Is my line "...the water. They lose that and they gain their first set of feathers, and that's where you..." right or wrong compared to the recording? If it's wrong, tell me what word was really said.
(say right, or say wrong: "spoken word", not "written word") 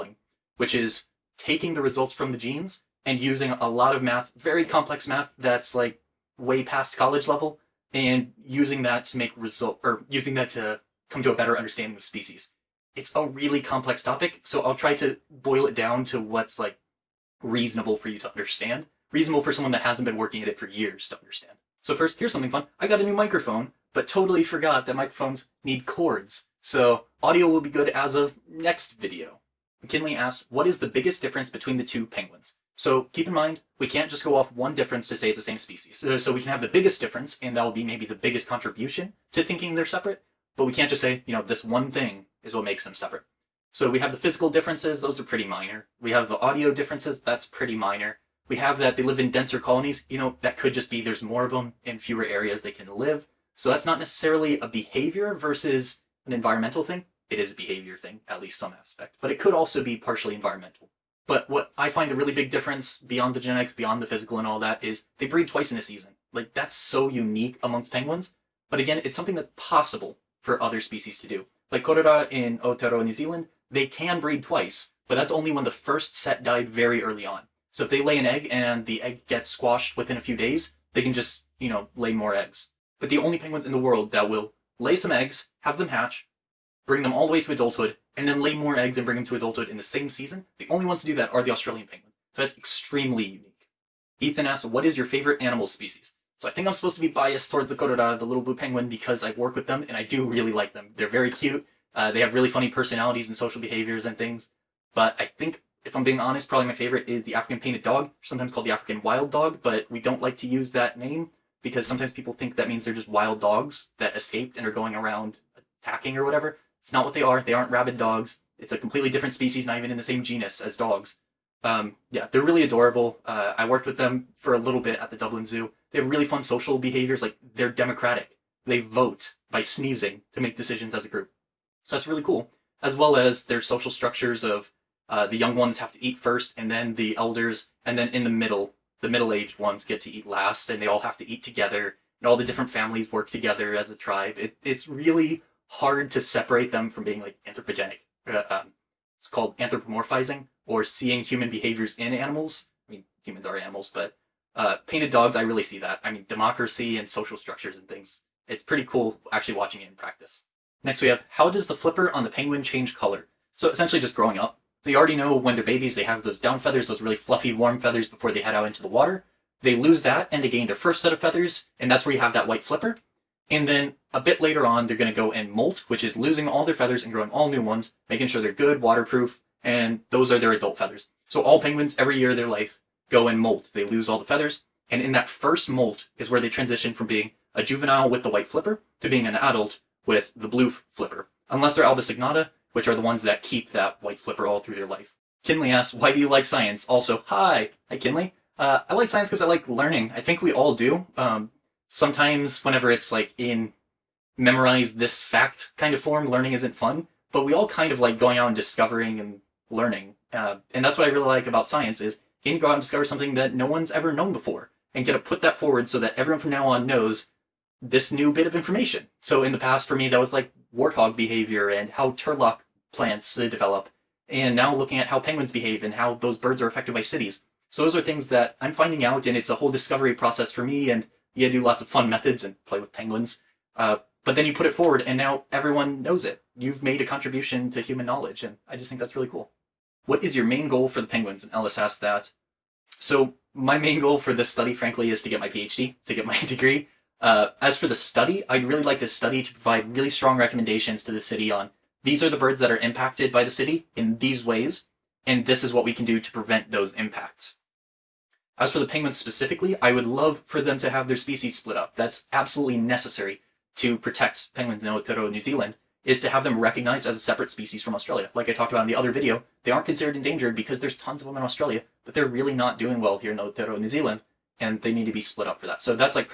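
right.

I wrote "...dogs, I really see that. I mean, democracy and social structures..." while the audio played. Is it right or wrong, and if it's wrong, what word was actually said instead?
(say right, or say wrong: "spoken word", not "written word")
right.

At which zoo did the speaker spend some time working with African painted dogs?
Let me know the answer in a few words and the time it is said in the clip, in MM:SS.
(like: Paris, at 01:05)
Dublin Zoo, at 02:05.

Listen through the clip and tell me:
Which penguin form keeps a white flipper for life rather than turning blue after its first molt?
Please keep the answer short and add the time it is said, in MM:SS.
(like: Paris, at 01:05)
Albosignata, at 03:11.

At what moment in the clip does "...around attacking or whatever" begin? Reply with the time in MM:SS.
01:54.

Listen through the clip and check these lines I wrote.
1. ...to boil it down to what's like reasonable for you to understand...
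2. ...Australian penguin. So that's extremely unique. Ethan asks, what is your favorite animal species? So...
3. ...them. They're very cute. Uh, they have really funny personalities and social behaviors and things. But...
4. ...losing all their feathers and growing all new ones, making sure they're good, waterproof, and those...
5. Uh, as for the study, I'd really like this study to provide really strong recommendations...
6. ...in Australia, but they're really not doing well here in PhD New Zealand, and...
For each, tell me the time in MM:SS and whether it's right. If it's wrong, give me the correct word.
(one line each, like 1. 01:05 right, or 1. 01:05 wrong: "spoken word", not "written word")
1. 00:14 right
2. 01:31 right
3. 01:40 right
4. 02:56 right
5. 04:07 right
6. 04:31 wrong: "Aotearoa", not "PhD".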